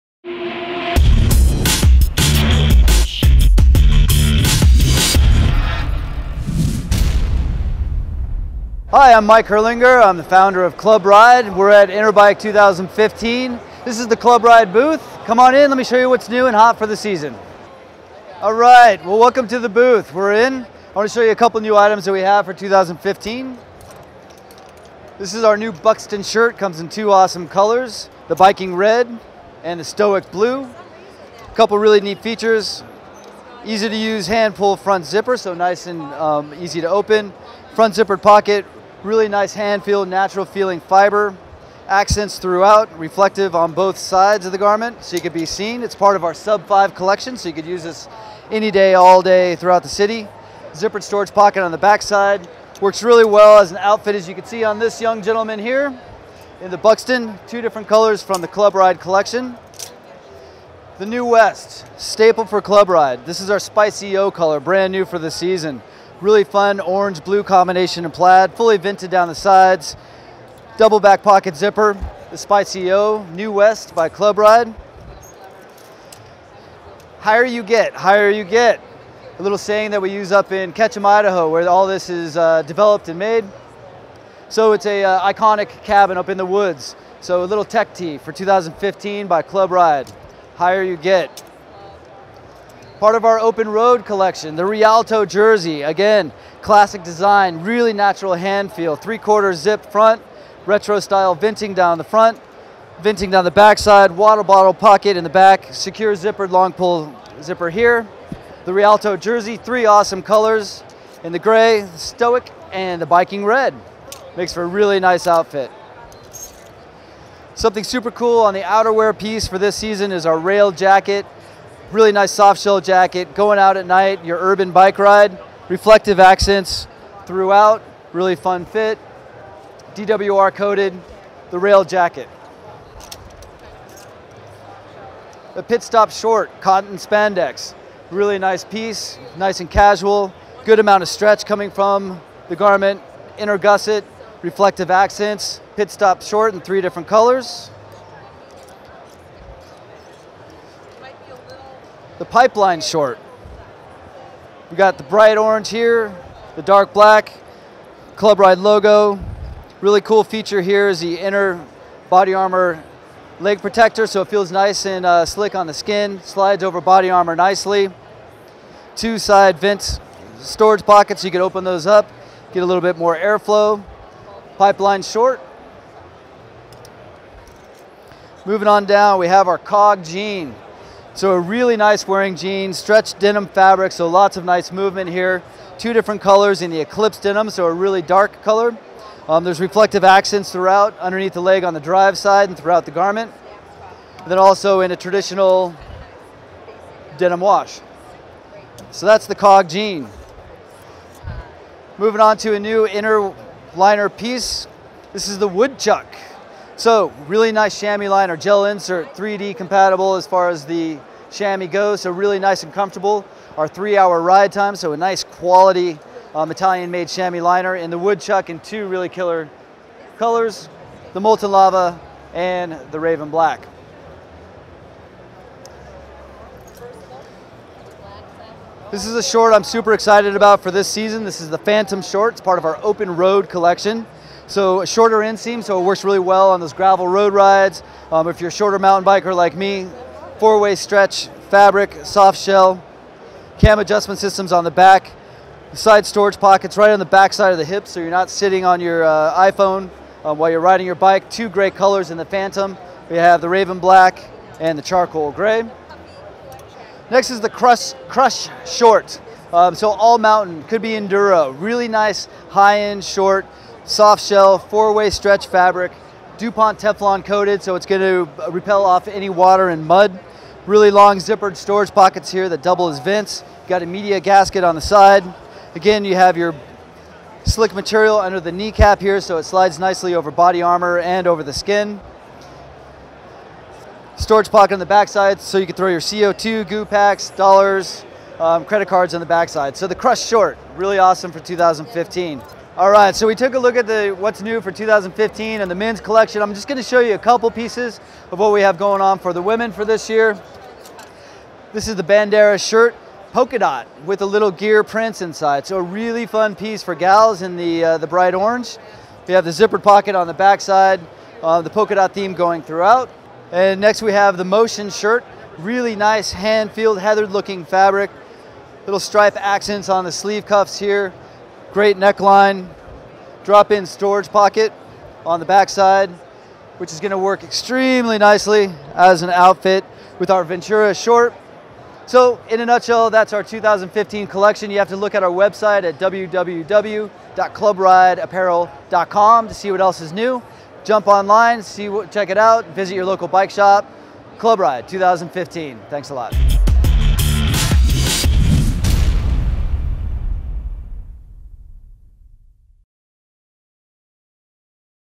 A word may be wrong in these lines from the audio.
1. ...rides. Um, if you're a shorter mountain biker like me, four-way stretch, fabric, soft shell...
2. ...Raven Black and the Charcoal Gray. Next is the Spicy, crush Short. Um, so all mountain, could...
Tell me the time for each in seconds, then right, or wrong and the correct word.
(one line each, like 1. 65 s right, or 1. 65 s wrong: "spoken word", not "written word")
1. 237 s right
2. 253 s wrong: "Crush", not "Spicy".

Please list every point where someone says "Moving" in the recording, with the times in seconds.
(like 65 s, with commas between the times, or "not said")
178 s, 201 s.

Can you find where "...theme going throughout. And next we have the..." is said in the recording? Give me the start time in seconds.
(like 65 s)
312 s.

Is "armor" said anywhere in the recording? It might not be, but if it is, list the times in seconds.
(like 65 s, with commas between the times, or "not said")
162 s, 167 s, 280 s.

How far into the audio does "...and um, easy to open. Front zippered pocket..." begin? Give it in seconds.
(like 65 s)
35 s.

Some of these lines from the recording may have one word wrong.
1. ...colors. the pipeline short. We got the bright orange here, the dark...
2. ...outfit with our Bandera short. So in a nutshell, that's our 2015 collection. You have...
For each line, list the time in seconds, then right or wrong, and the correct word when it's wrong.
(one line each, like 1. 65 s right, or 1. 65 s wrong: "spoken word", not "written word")
1. 147 s right
2. 329 s wrong: "Ventura", not "Bandera".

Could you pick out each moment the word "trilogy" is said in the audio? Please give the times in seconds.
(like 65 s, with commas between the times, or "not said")
not said.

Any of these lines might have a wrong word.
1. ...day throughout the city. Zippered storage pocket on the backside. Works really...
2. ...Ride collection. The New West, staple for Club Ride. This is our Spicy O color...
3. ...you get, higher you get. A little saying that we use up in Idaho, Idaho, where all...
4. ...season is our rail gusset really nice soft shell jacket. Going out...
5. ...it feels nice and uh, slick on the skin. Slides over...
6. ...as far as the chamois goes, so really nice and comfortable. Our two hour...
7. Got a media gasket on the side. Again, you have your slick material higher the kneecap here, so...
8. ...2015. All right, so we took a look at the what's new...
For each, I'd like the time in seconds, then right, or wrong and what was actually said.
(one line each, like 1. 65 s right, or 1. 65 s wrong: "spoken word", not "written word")
1. 49 s right
2. 58 s right
3. 77 s wrong: "Ketchum", not "Idaho"
4. 119 s wrong: "jacket", not "gusset"
5. 164 s right
6. 210 s wrong: "three", not "two"
7. 273 s wrong: "under", not "higher"
8. 291 s right.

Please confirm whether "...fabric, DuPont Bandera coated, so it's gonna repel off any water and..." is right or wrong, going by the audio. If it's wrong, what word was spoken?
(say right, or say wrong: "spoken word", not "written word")
wrong: "Teflon", not "Bandera".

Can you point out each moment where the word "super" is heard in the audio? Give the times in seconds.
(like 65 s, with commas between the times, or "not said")
117 s, 229 s.